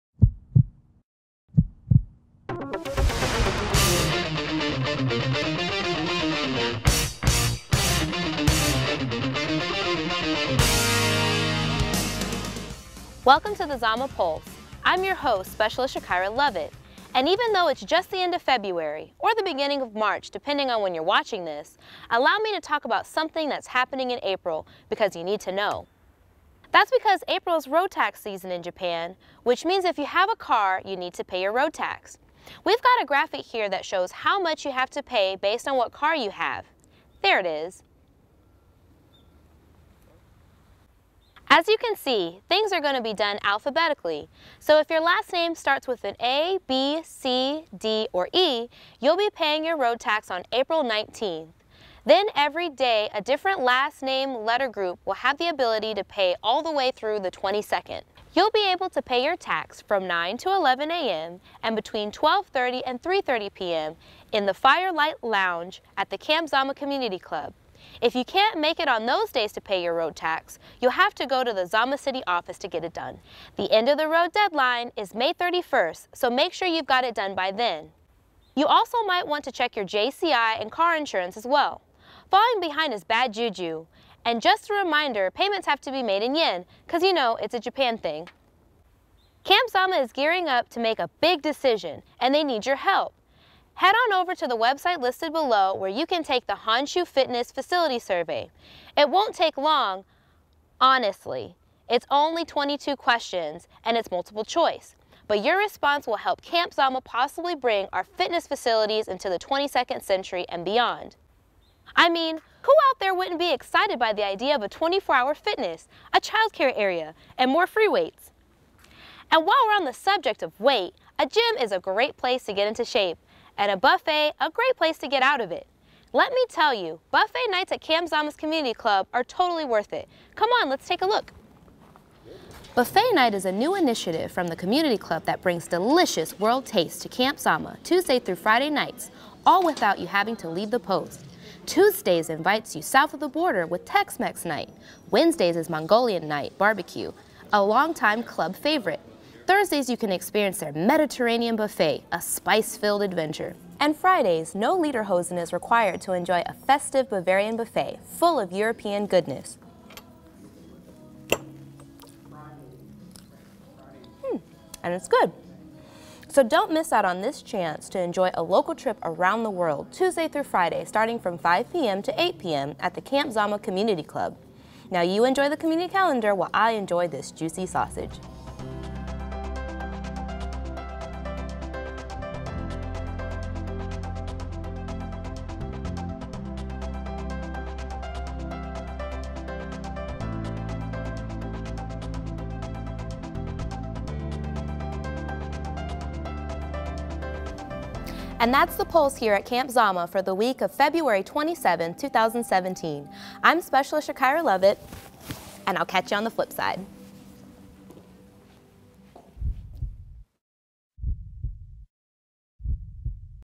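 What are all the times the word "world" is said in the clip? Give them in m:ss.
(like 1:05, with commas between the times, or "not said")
2:16, 2:49.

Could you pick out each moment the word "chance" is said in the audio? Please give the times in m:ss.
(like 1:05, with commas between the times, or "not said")
2:47.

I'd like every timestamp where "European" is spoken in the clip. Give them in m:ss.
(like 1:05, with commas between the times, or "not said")
2:38.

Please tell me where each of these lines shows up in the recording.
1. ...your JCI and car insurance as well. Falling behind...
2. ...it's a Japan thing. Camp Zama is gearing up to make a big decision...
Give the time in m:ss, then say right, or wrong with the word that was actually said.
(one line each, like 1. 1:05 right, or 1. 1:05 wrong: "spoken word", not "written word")
1. 1:19 right
2. 1:27 right.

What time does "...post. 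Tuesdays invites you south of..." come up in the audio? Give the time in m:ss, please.
2:20.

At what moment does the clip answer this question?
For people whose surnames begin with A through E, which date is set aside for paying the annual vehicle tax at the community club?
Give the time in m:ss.
0:50.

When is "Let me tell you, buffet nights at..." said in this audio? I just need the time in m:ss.
2:06.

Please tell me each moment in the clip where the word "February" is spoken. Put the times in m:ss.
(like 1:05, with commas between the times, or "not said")
0:18, 3:20.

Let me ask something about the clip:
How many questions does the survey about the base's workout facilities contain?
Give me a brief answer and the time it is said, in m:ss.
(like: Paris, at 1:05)
22, at 1:42.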